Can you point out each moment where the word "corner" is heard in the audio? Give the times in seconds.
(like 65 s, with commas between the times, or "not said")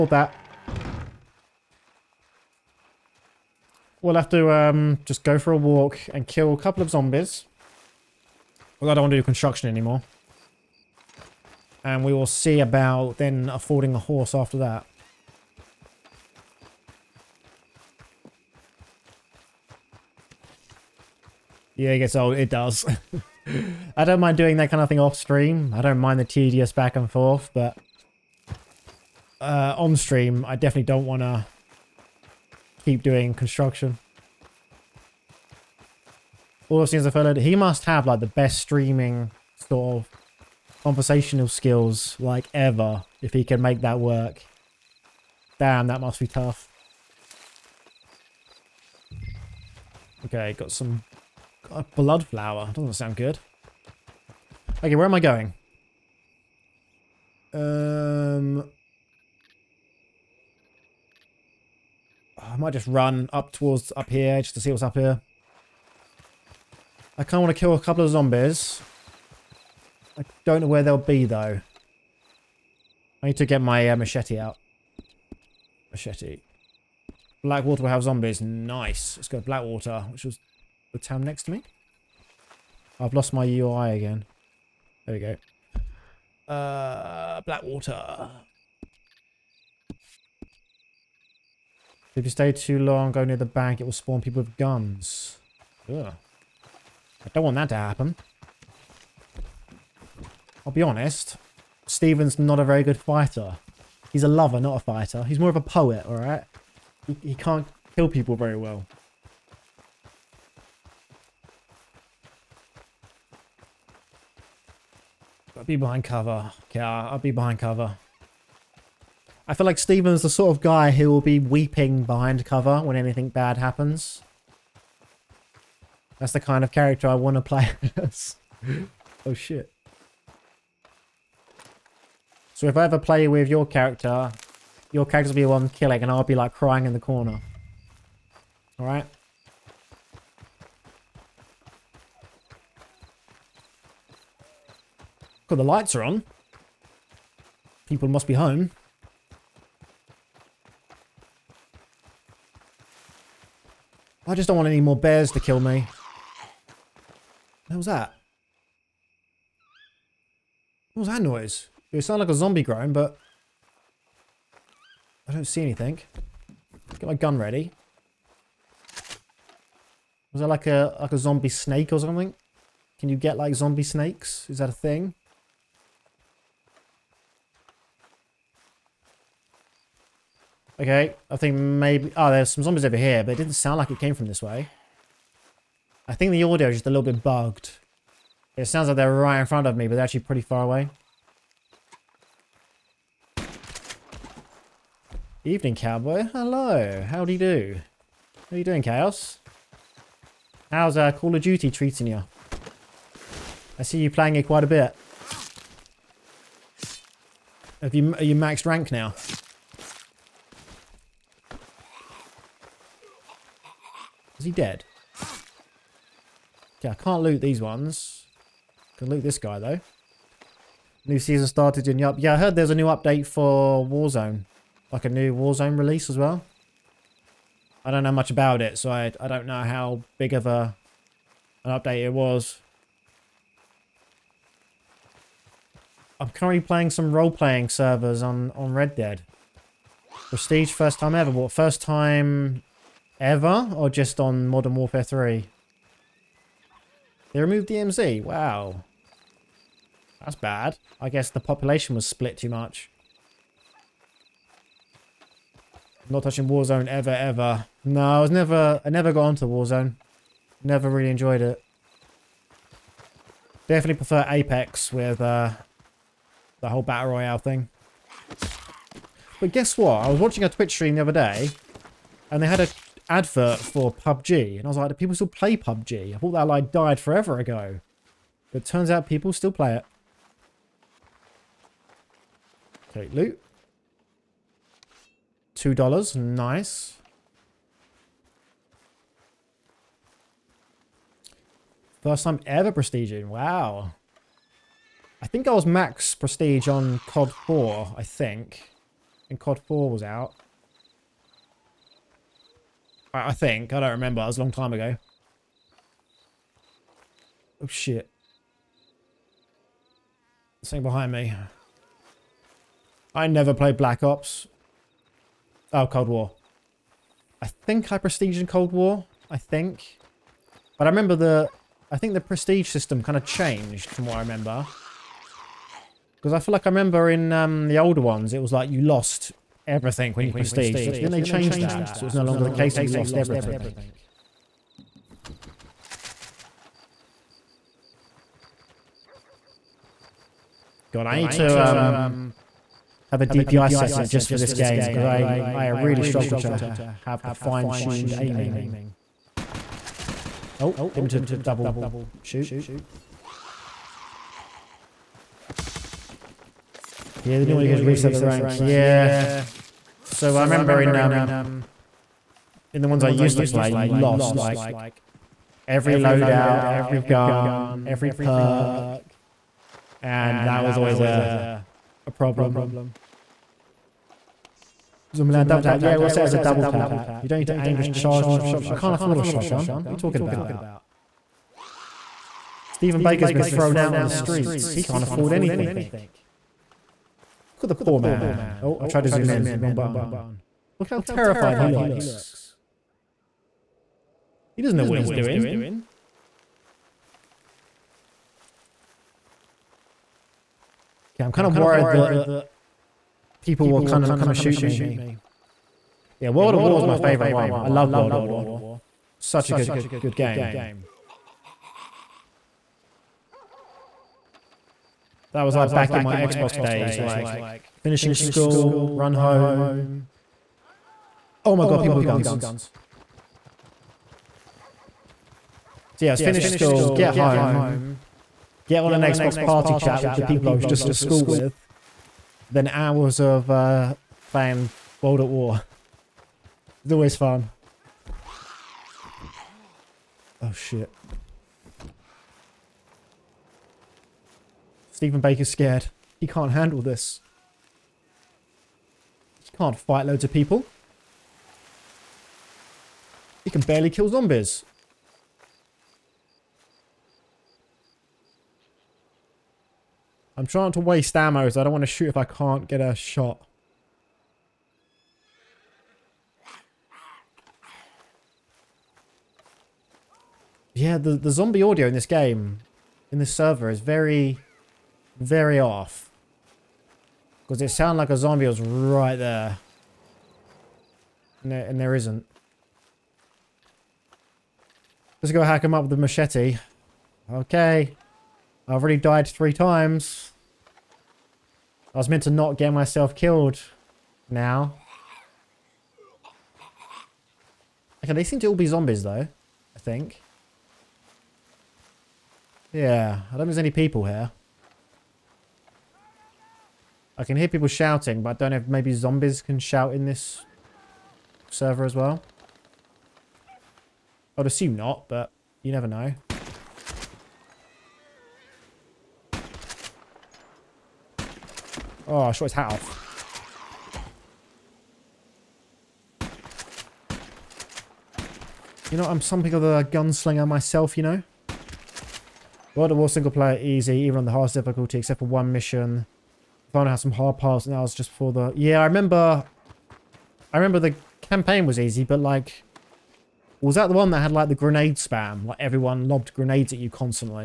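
136 s.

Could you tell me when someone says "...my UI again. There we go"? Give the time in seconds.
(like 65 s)
83 s.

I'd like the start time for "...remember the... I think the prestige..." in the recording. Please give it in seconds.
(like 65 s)
320 s.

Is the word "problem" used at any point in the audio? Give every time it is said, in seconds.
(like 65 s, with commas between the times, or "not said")
372 s.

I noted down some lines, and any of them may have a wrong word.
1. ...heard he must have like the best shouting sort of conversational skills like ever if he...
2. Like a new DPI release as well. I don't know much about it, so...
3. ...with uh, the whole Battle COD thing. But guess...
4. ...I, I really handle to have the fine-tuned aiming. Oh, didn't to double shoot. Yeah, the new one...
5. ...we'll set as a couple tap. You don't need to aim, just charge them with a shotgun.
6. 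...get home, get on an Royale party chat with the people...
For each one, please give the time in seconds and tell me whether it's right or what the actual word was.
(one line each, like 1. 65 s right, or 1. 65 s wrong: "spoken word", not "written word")
1. 37 s wrong: "streaming", not "shouting"
2. 224 s wrong: "Warzone", not "DPI"
3. 264 s wrong: "Royale", not "COD"
4. 345 s wrong: "struggle", not "handle"
5. 375 s wrong: "double", not "couple"
6. 426 s wrong: "Xbox", not "Royale".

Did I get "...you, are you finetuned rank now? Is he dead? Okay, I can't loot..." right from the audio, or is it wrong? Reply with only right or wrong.
wrong.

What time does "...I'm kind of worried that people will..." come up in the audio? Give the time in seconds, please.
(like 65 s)
401 s.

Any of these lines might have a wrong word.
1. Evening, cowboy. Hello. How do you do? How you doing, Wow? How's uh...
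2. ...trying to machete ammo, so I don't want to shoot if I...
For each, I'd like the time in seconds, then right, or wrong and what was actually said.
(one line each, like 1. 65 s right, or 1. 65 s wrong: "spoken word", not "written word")
1. 195 s wrong: "Chaos", not "Wow"
2. 460 s wrong: "waste", not "machete".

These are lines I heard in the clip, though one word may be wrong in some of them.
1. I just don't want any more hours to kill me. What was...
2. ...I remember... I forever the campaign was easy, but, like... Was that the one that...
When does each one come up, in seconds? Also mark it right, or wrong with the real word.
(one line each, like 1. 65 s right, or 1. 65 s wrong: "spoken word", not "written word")
1. 154 s wrong: "bears", not "hours"
2. 538 s wrong: "remember", not "forever".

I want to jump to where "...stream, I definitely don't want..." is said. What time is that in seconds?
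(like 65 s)
29 s.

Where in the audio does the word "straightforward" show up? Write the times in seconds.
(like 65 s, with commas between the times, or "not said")
not said.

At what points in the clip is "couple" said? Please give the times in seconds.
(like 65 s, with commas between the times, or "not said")
6 s, 67 s.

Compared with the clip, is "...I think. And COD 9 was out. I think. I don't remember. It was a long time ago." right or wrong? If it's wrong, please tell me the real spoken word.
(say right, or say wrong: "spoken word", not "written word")
wrong: "4", not "9".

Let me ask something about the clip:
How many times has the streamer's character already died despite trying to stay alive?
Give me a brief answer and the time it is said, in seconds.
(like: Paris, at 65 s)
3, at 489 s.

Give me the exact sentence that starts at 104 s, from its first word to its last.
He's a lover, not a fighter.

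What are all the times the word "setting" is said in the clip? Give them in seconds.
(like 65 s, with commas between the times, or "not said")
343 s.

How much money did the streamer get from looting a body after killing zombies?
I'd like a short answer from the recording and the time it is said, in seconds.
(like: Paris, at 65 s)
2 dollars, at 285 s.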